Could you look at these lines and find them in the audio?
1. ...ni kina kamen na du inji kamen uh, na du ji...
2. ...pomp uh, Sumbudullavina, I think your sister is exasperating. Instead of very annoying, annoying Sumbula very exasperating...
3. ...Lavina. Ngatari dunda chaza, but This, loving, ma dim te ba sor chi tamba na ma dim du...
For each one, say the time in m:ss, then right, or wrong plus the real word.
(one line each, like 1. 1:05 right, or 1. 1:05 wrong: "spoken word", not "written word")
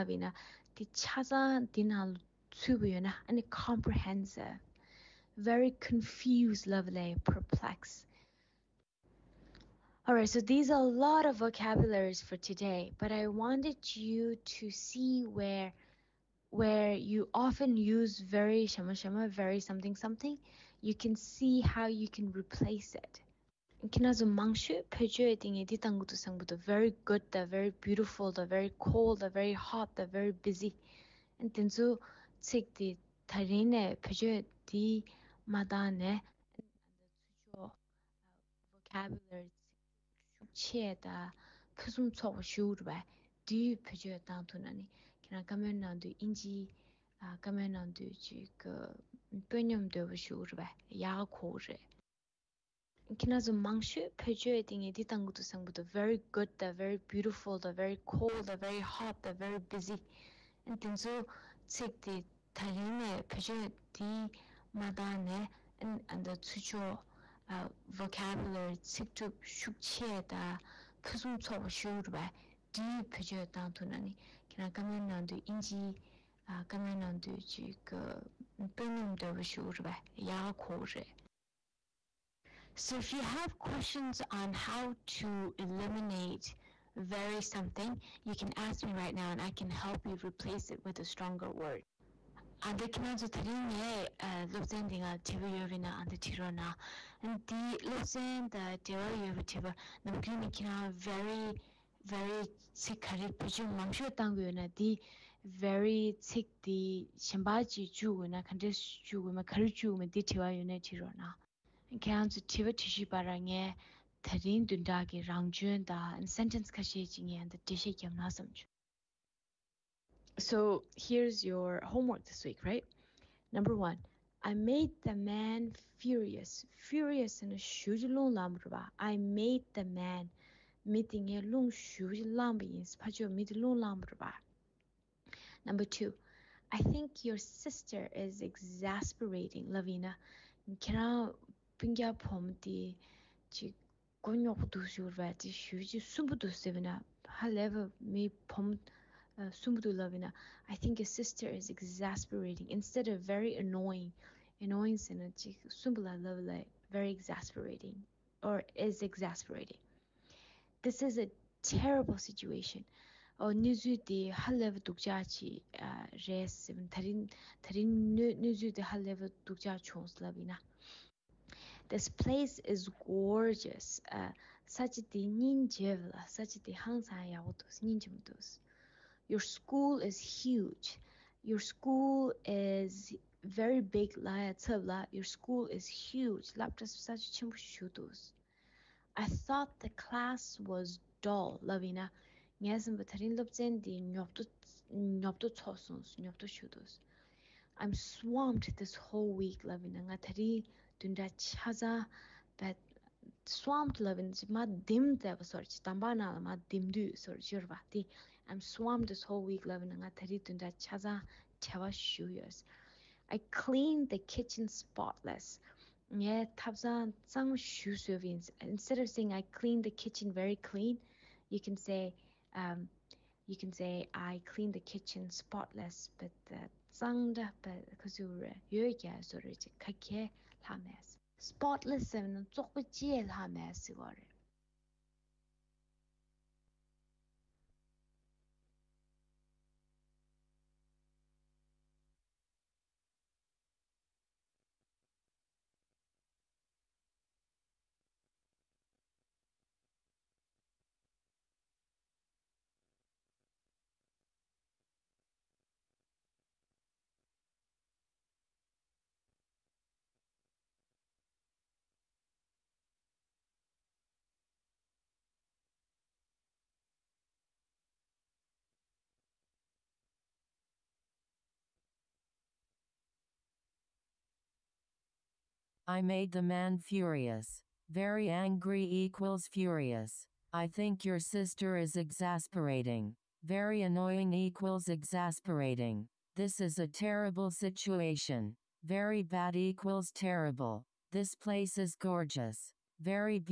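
1. 1:13 right
2. 2:28 right
3. 3:19 wrong: "Swamped", not "This".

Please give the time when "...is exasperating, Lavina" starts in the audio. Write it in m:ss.
2:18.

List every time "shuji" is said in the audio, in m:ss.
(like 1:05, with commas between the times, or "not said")
2:11, 2:24.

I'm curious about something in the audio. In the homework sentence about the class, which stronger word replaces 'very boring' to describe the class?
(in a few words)
dull.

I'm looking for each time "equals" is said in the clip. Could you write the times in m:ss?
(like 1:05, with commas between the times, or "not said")
4:38, 4:44, 4:49.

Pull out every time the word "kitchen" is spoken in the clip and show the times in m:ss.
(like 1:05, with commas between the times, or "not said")
3:34, 3:40, 3:44.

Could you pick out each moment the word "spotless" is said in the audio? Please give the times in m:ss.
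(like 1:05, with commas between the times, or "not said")
3:34, 3:45, 3:51.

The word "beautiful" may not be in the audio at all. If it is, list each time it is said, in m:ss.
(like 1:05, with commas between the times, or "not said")
0:27, 0:57.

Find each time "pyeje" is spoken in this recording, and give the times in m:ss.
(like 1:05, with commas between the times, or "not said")
1:13.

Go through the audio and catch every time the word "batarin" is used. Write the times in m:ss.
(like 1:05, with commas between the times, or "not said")
3:12.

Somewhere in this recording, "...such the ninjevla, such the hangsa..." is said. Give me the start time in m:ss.
2:54.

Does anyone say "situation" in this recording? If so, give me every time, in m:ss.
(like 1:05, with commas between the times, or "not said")
2:42, 4:47.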